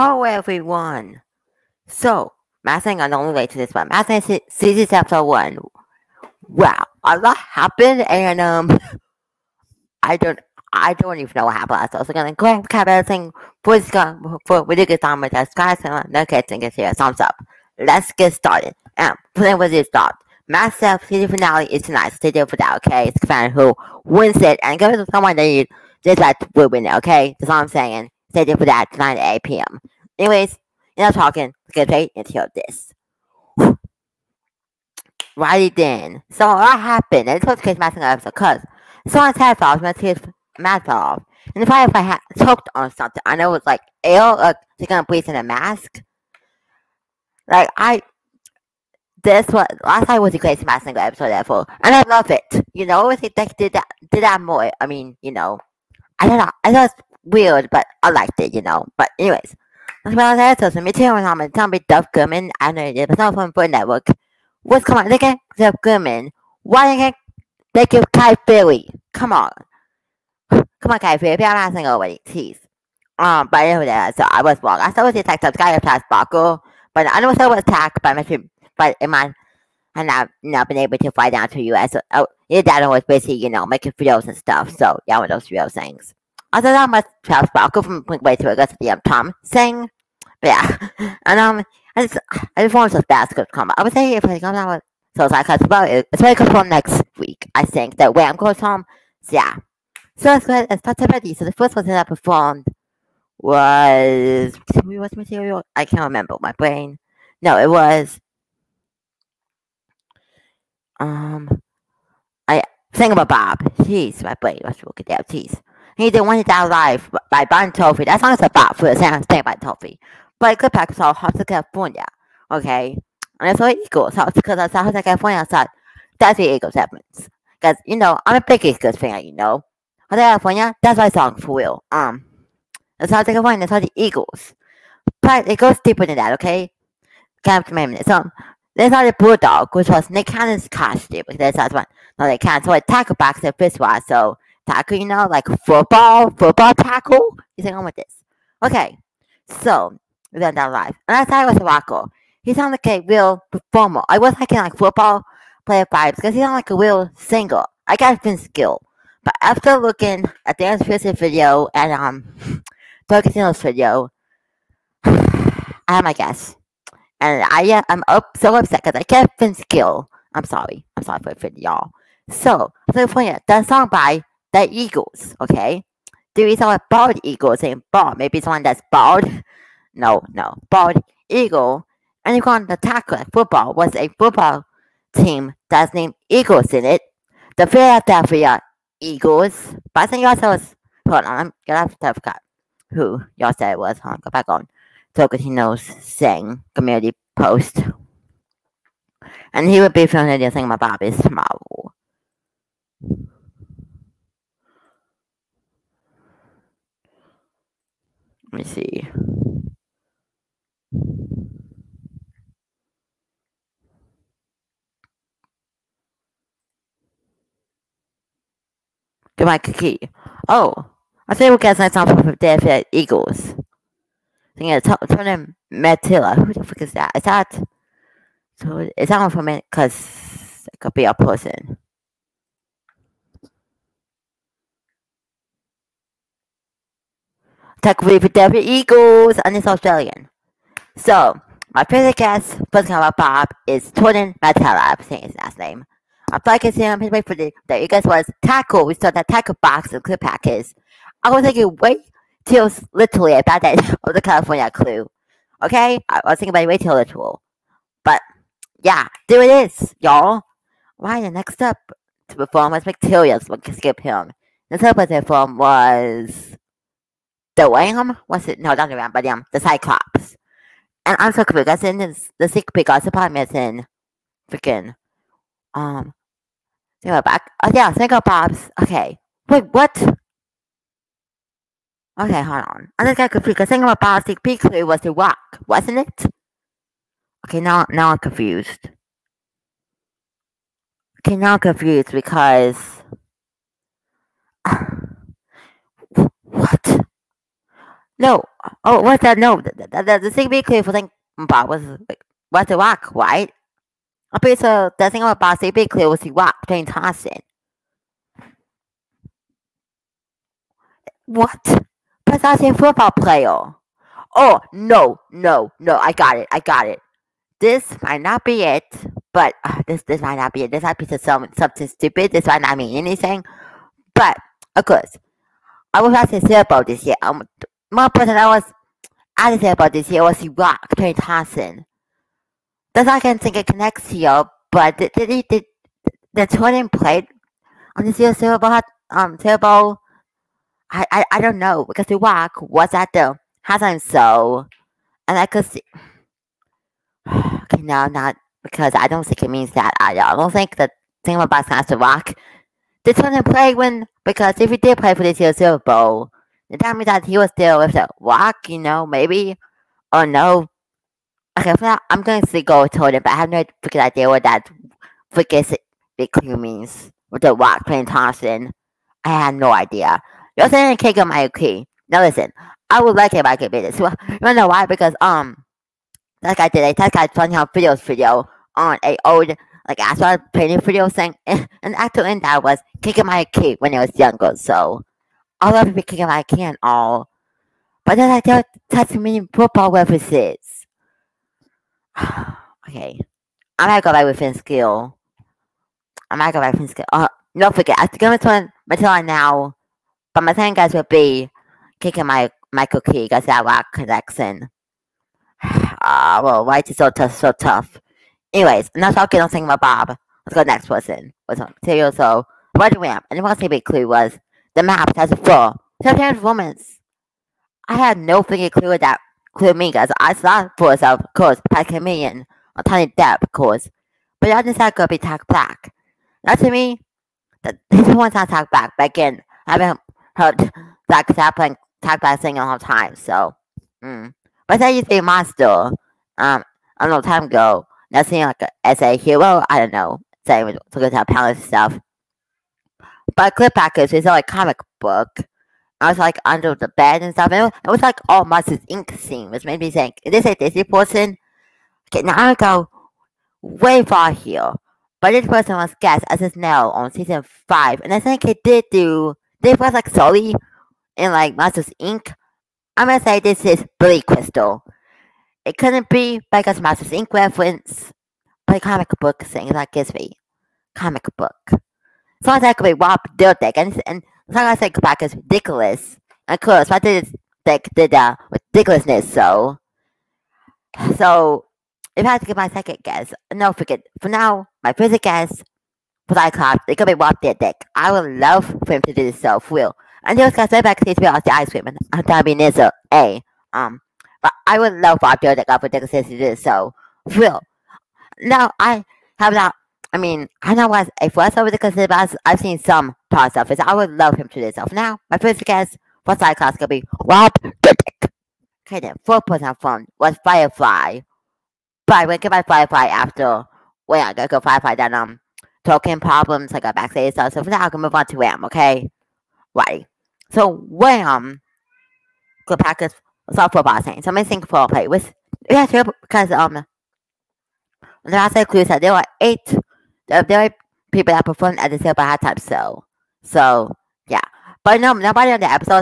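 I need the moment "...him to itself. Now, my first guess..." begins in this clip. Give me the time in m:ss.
8:24.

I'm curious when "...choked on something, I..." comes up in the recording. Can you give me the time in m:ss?
0:42.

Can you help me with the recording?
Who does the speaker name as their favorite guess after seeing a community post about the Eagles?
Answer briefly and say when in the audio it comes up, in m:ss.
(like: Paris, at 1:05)
Jordan Mailata, at 4:03.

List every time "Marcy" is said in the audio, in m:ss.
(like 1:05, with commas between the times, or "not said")
7:28.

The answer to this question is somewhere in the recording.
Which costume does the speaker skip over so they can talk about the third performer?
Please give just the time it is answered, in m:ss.
4:29.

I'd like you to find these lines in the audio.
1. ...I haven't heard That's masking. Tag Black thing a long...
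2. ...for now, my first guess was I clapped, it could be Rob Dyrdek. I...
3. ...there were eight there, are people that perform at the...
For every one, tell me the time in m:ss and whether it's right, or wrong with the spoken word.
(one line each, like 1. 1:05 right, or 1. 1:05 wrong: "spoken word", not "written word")
1. 7:09 wrong: "happening", not "masking"
2. 8:04 right
3. 8:49 right.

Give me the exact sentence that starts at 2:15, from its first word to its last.
But it goes deeper than that, okay?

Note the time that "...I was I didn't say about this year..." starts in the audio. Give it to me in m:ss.
5:28.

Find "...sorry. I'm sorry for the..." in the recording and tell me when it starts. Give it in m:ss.
2:50.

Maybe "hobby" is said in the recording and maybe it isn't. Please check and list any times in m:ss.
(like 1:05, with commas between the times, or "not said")
not said.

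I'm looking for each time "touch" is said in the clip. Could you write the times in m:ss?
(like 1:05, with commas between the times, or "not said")
6:28.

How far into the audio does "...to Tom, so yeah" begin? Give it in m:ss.
1:38.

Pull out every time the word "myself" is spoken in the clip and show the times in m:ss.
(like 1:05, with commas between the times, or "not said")
0:20, 7:00.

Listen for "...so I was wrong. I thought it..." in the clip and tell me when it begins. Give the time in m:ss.
1:14.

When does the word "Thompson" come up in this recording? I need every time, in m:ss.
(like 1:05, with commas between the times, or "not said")
5:06, 5:31, 6:08.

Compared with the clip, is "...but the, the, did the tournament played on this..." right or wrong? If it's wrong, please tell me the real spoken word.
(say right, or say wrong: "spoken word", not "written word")
right.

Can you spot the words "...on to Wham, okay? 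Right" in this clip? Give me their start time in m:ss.
8:38.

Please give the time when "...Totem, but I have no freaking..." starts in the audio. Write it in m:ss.
6:02.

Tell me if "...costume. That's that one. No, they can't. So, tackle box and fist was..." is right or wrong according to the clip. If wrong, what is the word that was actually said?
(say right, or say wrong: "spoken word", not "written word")
right.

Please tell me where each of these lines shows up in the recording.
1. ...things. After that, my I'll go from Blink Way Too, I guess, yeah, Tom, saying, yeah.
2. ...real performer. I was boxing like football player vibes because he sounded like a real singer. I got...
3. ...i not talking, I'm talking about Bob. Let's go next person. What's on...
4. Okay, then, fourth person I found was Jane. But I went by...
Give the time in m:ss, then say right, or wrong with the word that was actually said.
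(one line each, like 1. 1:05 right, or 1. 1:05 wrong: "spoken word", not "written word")
1. 1:25 right
2. 2:33 wrong: "liking", not "boxing"
3. 6:48 right
4. 8:28 wrong: "Firefly", not "Jane".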